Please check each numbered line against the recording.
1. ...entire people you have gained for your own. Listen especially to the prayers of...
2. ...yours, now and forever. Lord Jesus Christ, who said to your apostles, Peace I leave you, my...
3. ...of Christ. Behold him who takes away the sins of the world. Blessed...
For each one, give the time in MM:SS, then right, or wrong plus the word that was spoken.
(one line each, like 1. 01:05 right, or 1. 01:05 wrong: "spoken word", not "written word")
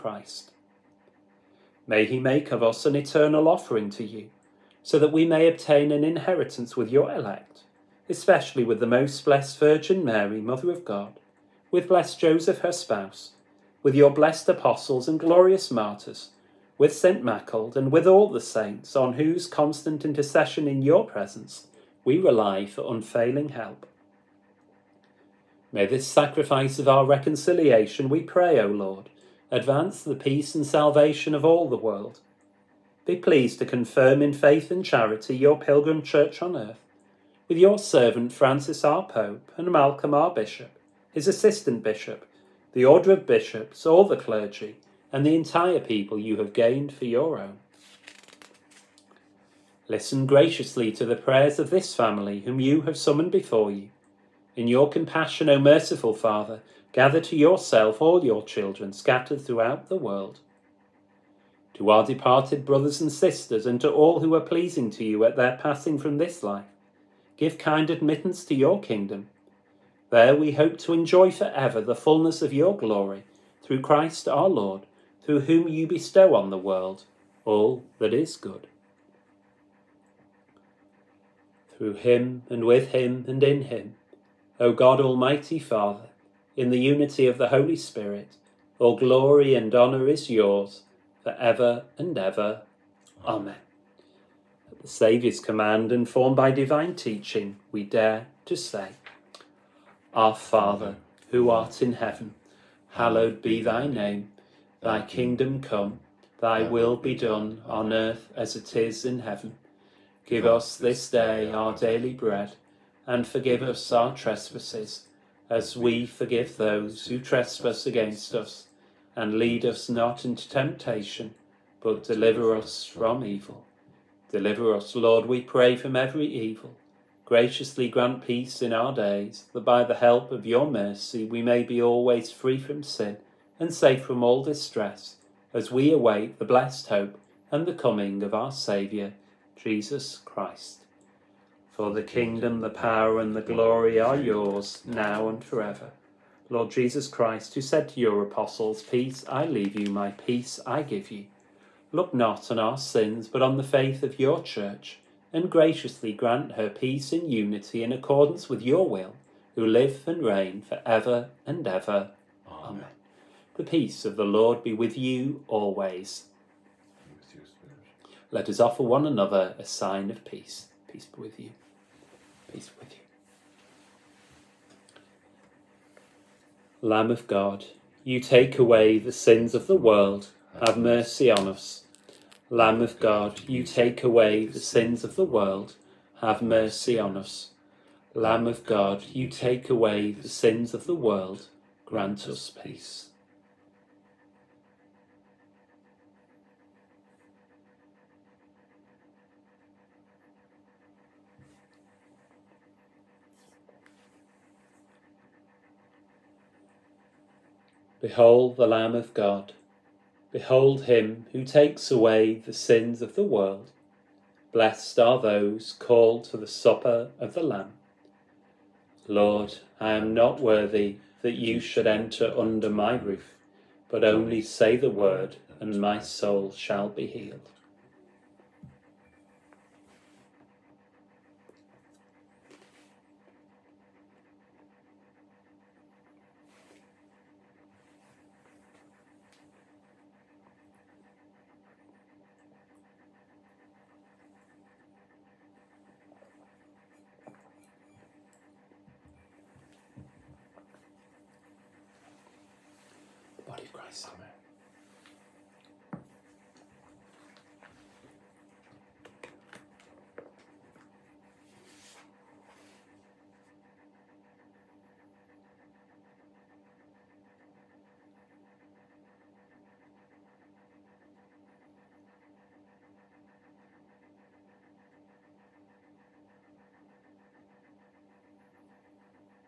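1. 00:45 wrong: "graciously", not "especially"
2. 02:24 right
3. 03:28 wrong: "God", not "Christ".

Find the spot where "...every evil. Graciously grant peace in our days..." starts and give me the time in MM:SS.
02:05.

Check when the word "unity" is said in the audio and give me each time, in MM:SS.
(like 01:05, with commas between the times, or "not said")
01:26, 02:37.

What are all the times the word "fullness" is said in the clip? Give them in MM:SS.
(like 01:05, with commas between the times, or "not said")
01:11.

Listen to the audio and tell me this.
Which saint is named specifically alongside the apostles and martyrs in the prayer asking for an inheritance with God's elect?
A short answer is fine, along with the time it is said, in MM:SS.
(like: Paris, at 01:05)
St. Maccled, at 00:16.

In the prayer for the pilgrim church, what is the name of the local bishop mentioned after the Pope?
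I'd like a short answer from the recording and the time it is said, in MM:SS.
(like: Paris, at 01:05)
Malcolm, at 00:39.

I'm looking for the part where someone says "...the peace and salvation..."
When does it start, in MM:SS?
00:30.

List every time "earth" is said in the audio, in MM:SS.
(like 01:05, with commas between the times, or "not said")
00:36, 01:47.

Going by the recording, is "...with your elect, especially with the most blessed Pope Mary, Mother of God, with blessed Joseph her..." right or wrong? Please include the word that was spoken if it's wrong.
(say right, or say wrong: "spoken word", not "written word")
wrong: "Virgin", not "Pope".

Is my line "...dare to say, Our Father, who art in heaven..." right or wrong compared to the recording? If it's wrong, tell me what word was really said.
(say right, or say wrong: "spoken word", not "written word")
right.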